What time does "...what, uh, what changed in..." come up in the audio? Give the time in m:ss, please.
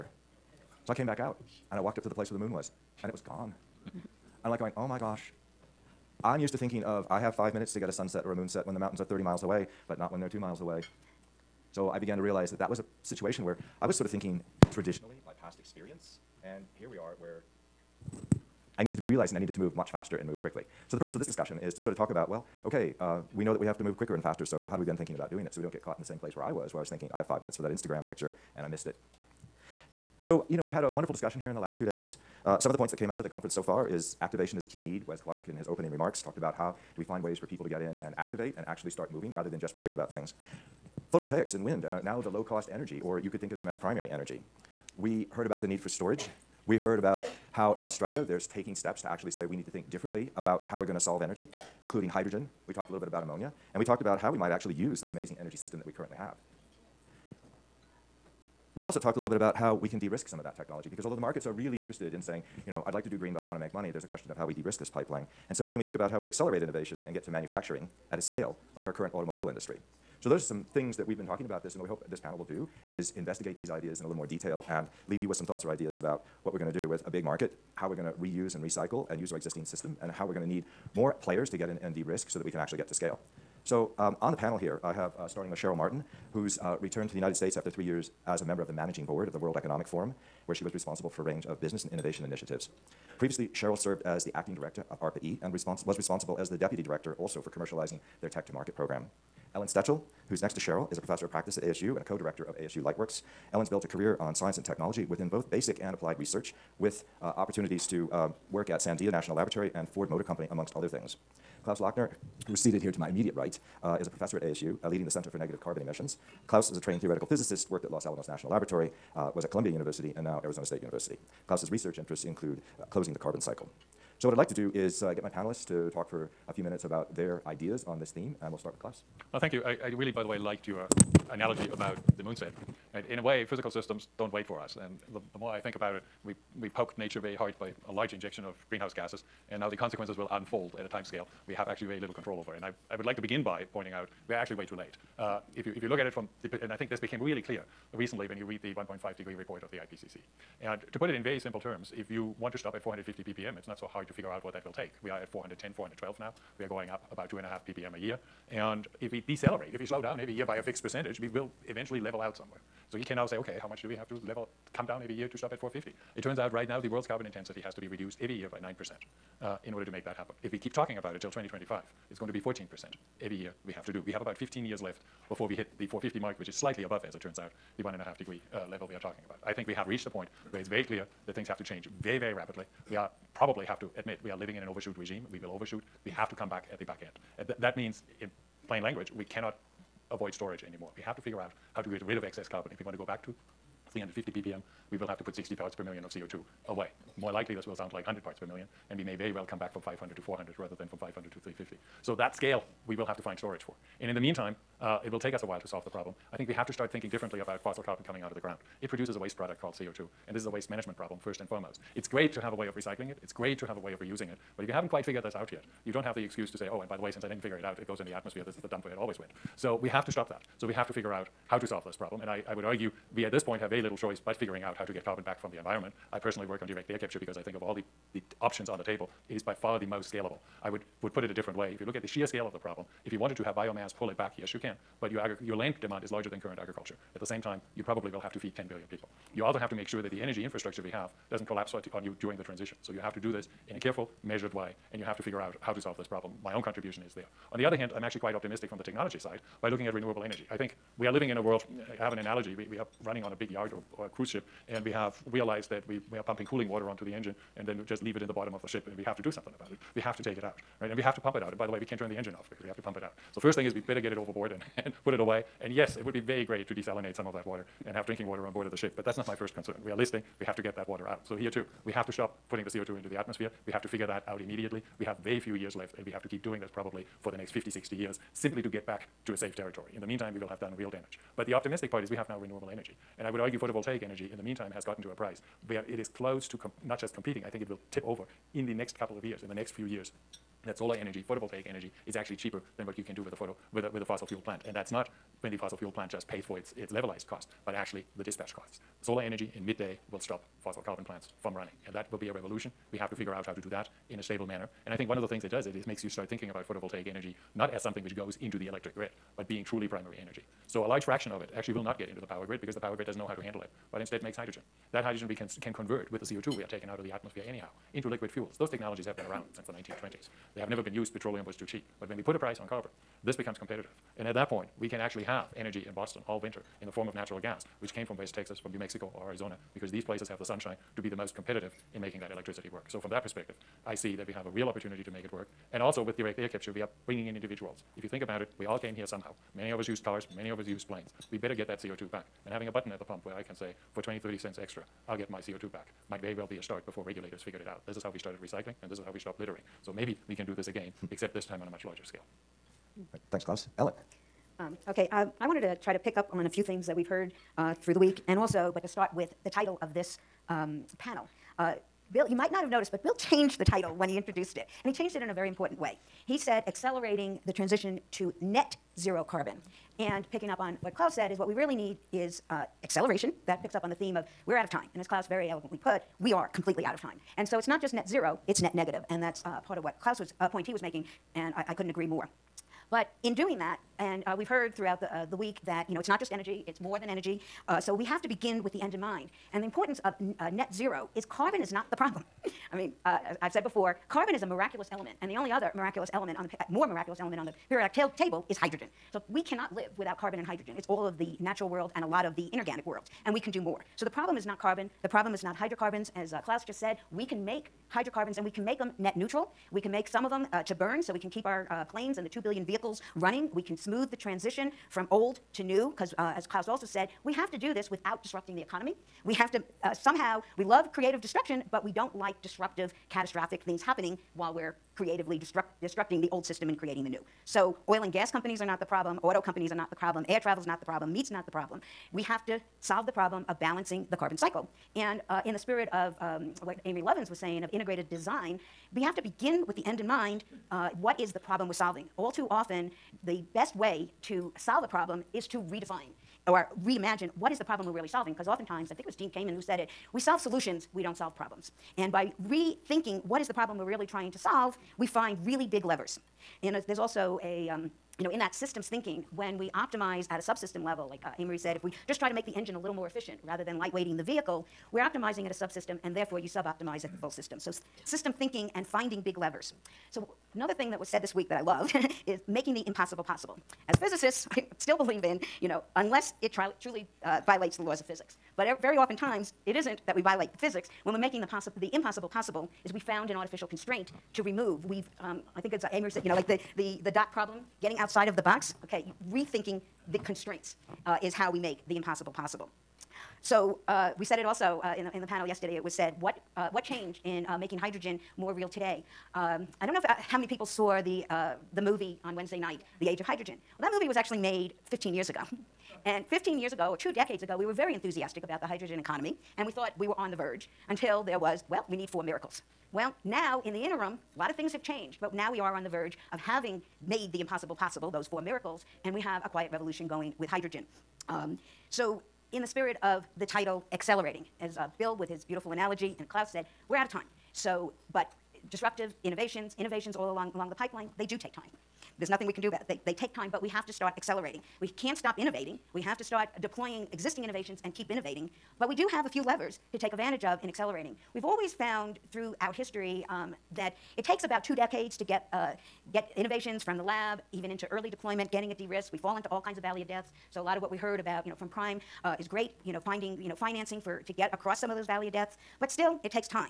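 8:16.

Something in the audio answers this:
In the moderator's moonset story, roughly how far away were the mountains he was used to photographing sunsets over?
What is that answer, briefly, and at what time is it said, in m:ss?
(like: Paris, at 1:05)
30 miles, at 0:09.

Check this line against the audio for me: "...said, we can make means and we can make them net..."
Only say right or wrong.
wrong.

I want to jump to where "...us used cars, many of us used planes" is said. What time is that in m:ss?
5:39.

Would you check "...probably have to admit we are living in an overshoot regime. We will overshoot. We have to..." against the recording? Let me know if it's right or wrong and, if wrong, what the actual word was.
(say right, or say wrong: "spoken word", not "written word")
right.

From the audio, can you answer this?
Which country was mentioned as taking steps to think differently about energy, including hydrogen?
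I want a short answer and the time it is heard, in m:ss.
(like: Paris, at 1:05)
Australia, at 0:47.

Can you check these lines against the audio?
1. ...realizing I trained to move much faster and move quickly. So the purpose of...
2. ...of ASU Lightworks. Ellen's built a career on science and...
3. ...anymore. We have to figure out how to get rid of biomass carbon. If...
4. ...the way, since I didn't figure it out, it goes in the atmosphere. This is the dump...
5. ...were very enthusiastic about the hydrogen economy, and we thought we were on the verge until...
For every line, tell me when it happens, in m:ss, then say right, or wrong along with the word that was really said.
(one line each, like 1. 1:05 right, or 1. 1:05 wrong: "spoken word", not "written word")
1. 0:19 wrong: "needed", not "trained"
2. 1:42 right
3. 3:10 wrong: "excess", not "biomass"
4. 3:36 right
5. 8:27 right.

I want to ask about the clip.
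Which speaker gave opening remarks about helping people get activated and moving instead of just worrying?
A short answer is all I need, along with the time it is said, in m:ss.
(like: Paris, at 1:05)
Wes Clark, at 0:35.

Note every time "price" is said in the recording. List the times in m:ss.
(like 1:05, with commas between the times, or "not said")
4:45, 5:22.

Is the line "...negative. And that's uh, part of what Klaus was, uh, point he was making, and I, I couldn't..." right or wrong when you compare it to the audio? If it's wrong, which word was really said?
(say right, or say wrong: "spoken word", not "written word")
right.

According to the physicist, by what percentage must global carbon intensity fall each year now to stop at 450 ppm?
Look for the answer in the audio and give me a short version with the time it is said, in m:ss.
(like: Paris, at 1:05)
9%, at 2:48.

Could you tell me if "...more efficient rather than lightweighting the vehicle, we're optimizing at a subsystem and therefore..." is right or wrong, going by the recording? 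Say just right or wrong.
right.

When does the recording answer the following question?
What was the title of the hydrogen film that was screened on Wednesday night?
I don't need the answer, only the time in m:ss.
8:22.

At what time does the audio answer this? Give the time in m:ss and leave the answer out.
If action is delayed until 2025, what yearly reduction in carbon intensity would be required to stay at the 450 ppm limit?
2:52.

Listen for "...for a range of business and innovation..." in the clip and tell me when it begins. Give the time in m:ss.
1:31.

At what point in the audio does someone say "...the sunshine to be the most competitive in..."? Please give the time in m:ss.
5:30.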